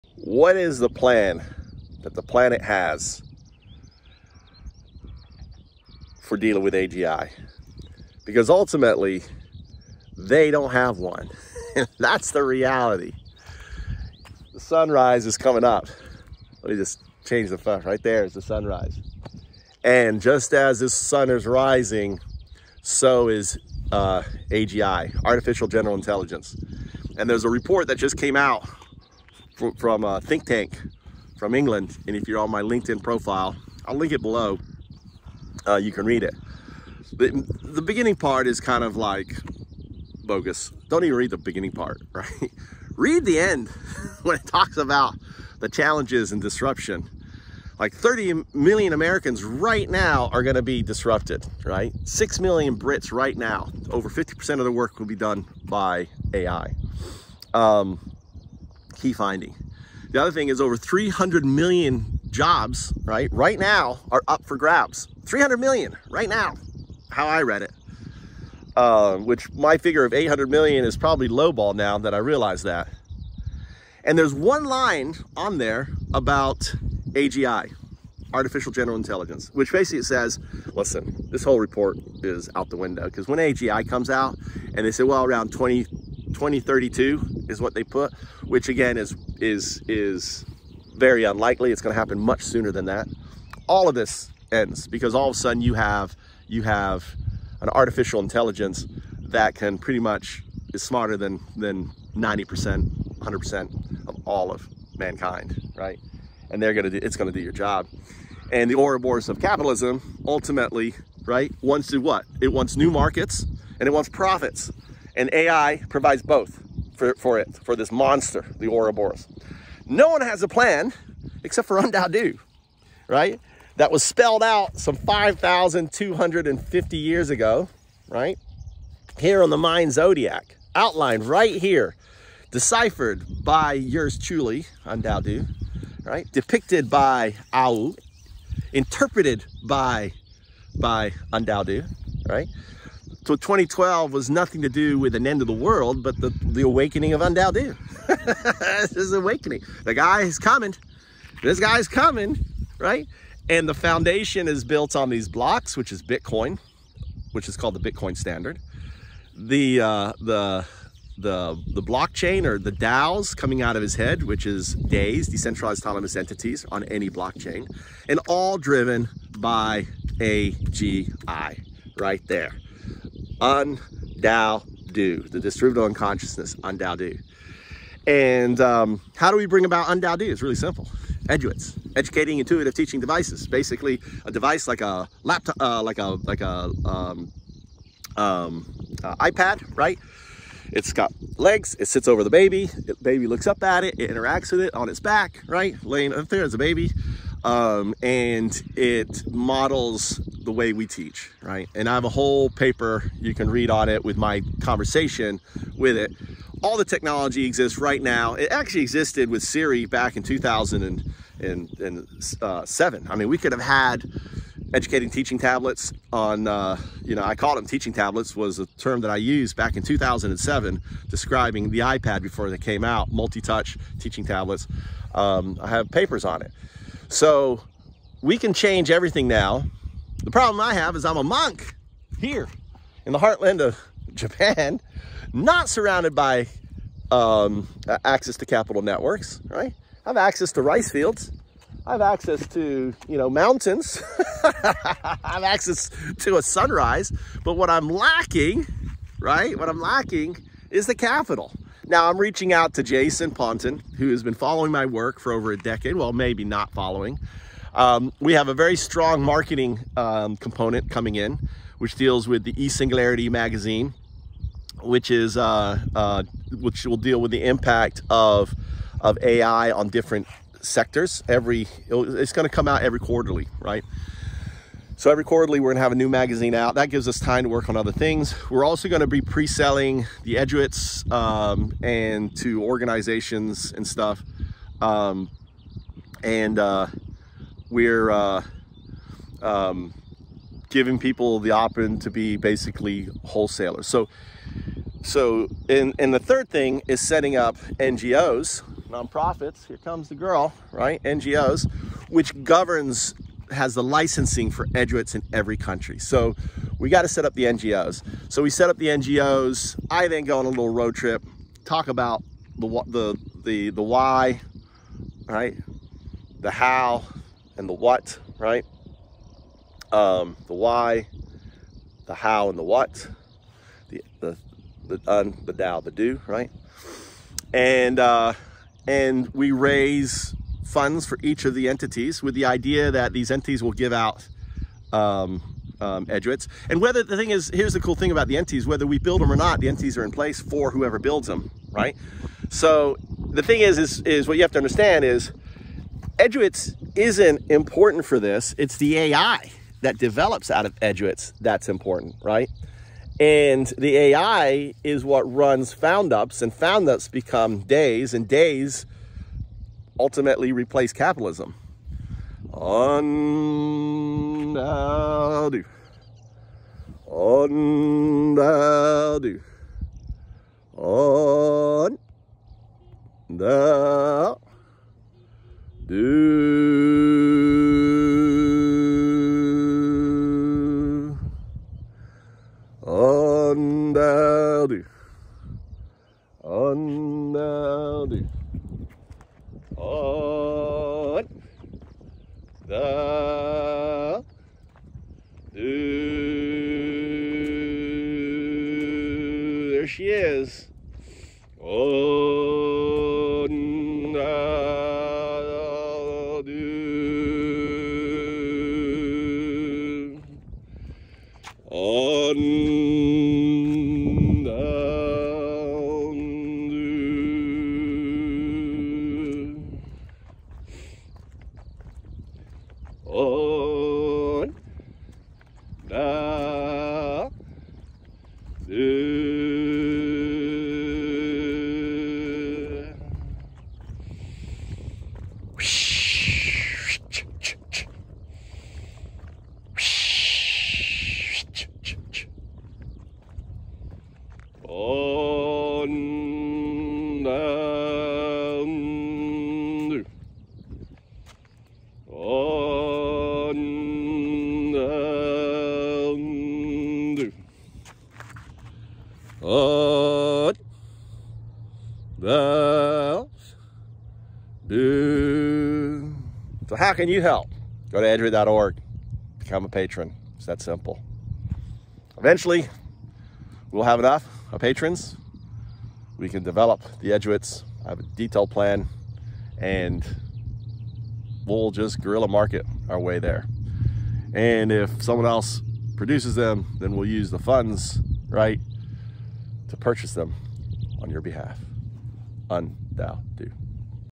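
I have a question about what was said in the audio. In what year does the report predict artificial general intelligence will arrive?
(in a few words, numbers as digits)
2032.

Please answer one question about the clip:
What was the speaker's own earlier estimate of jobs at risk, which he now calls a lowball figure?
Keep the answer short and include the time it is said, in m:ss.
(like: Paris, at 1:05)
800 million, at 1:10.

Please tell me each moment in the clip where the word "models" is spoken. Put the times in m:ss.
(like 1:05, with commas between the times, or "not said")
3:19.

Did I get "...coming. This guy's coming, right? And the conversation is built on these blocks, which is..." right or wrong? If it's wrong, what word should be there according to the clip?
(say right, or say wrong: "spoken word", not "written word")
wrong: "foundation", not "conversation".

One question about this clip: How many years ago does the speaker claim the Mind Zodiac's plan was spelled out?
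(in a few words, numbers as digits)
5,250.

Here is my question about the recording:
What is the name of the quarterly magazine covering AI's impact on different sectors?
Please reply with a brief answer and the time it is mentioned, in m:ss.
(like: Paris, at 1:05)
eSingularity, at 4:22.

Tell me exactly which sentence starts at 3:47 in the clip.
So we can change everything now.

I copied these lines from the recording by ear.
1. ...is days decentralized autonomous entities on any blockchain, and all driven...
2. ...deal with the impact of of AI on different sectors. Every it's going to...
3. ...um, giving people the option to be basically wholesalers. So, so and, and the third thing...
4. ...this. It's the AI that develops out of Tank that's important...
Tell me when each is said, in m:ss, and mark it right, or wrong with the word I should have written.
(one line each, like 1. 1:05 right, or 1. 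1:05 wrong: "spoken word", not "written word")
1. 2:44 right
2. 4:26 right
3. 4:49 right
4. 5:48 wrong: "EDUITs", not "Tank".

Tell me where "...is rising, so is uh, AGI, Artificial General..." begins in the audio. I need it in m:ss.
0:21.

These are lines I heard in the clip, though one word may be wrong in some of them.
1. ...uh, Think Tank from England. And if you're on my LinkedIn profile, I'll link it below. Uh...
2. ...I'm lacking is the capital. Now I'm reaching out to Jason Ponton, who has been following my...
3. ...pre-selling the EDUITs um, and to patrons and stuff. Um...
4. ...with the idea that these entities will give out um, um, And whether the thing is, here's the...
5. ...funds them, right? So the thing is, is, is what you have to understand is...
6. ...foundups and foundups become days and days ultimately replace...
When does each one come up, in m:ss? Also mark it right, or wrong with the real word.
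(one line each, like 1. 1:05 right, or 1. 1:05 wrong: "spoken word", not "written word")
1. 0:30 right
2. 4:09 right
3. 4:39 wrong: "organizations", not "patrons"
4. 5:32 right
5. 5:40 wrong: "builds", not "funds"
6. 5:55 right.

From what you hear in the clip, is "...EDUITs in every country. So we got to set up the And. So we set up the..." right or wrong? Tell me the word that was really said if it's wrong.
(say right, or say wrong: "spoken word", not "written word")
wrong: "NGOs", not "And".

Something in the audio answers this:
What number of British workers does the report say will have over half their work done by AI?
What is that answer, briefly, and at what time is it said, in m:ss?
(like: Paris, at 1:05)
6 million, at 0:52.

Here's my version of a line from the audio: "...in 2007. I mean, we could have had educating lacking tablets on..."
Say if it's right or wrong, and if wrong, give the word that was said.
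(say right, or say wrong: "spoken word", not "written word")
wrong: "teaching", not "lacking".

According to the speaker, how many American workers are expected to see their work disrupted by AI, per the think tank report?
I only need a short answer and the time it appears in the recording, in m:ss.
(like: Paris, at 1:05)
30 million, at 0:47.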